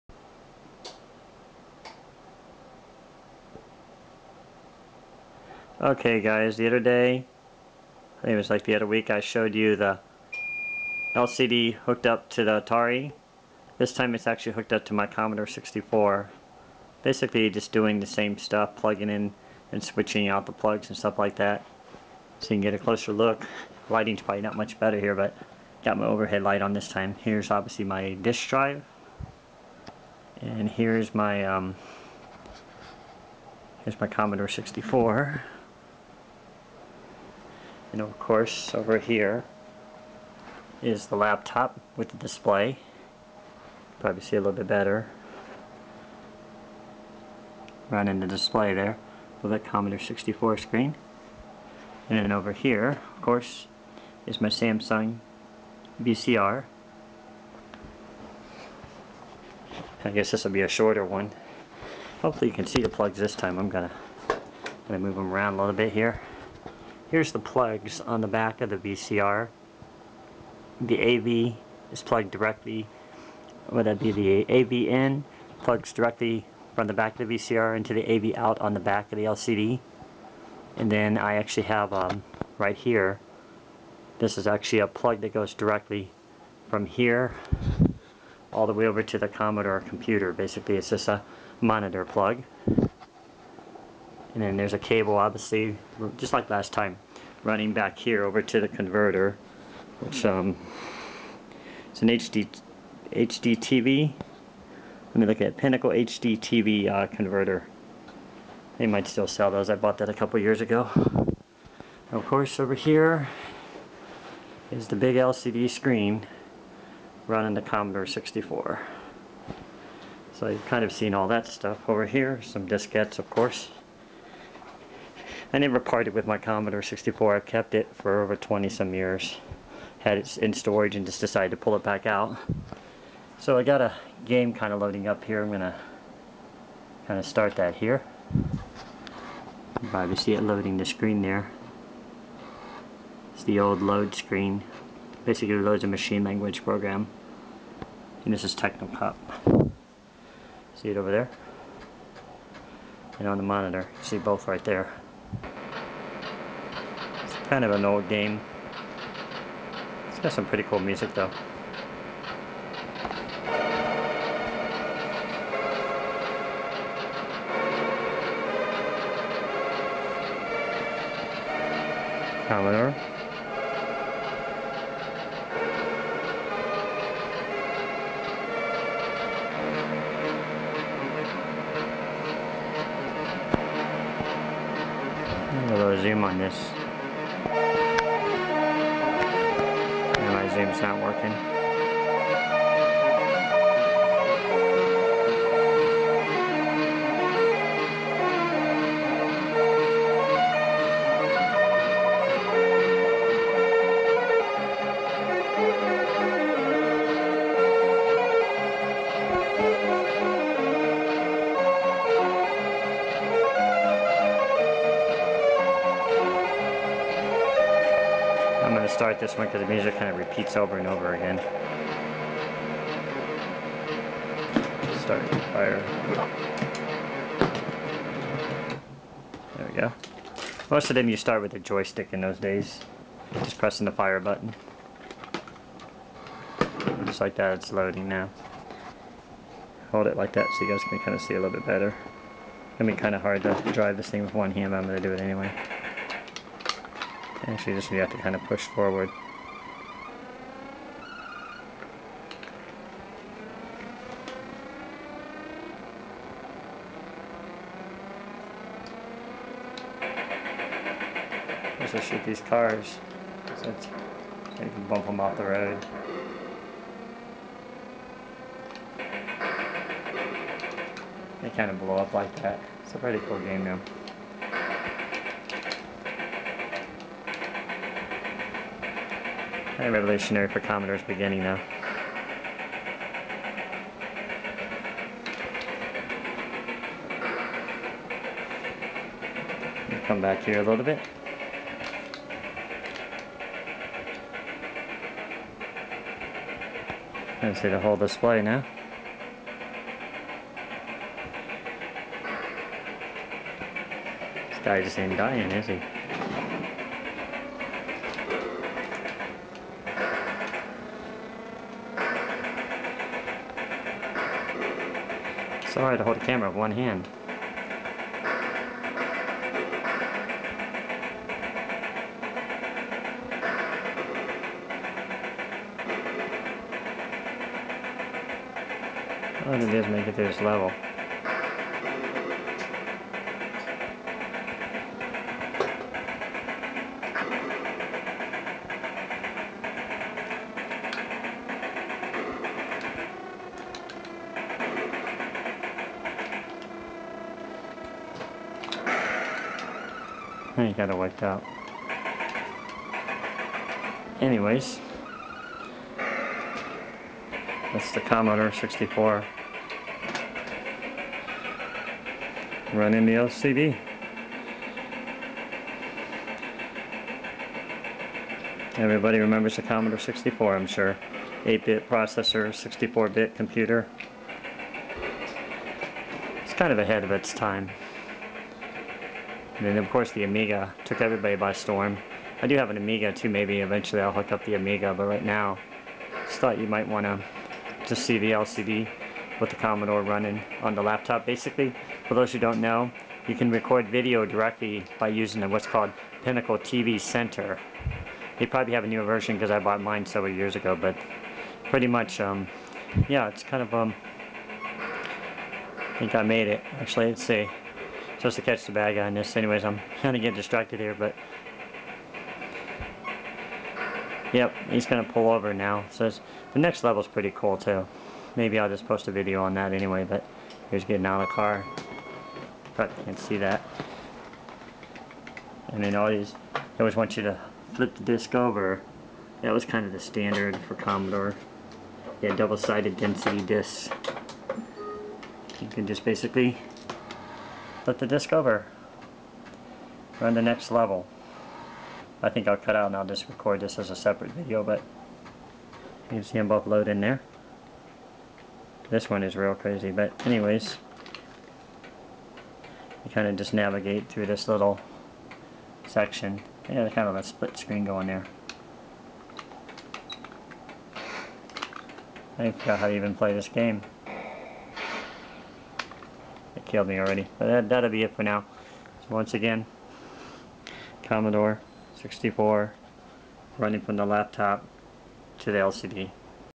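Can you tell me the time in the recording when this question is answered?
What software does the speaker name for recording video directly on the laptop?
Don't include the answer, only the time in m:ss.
6:36.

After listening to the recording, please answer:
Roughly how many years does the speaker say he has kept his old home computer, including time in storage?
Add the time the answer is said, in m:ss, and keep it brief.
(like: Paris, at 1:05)
over 20, at 2:08.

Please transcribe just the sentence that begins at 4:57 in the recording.
I see the whole display now.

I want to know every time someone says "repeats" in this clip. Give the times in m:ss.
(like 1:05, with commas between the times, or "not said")
3:40.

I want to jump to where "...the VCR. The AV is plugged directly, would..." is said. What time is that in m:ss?
1:08.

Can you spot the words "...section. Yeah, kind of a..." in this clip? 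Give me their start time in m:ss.
7:35.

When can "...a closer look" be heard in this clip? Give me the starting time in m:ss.
0:22.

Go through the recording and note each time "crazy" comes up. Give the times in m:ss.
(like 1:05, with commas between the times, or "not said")
7:29.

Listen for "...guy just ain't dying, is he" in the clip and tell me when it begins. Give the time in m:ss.
5:04.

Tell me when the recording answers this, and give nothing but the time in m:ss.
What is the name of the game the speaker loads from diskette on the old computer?
2:28.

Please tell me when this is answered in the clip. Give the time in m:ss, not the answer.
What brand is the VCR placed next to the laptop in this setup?
0:54.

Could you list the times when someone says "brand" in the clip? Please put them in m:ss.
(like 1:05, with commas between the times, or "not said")
not said.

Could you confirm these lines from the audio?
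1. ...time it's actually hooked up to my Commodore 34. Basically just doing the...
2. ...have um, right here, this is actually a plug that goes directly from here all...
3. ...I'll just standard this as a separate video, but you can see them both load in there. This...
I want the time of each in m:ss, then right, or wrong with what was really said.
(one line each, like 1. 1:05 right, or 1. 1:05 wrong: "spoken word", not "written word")
1. 0:13 wrong: "64", not "34"
2. 1:21 right
3. 7:22 wrong: "record", not "standard".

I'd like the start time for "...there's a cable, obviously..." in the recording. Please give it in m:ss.
1:34.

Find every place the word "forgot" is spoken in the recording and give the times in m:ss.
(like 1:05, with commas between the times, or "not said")
7:42.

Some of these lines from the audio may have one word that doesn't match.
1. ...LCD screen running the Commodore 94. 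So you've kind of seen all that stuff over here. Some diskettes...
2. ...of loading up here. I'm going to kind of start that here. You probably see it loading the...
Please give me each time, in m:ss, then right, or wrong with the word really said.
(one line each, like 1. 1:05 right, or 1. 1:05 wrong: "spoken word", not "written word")
1. 1:55 wrong: "64", not "94"
2. 2:14 right.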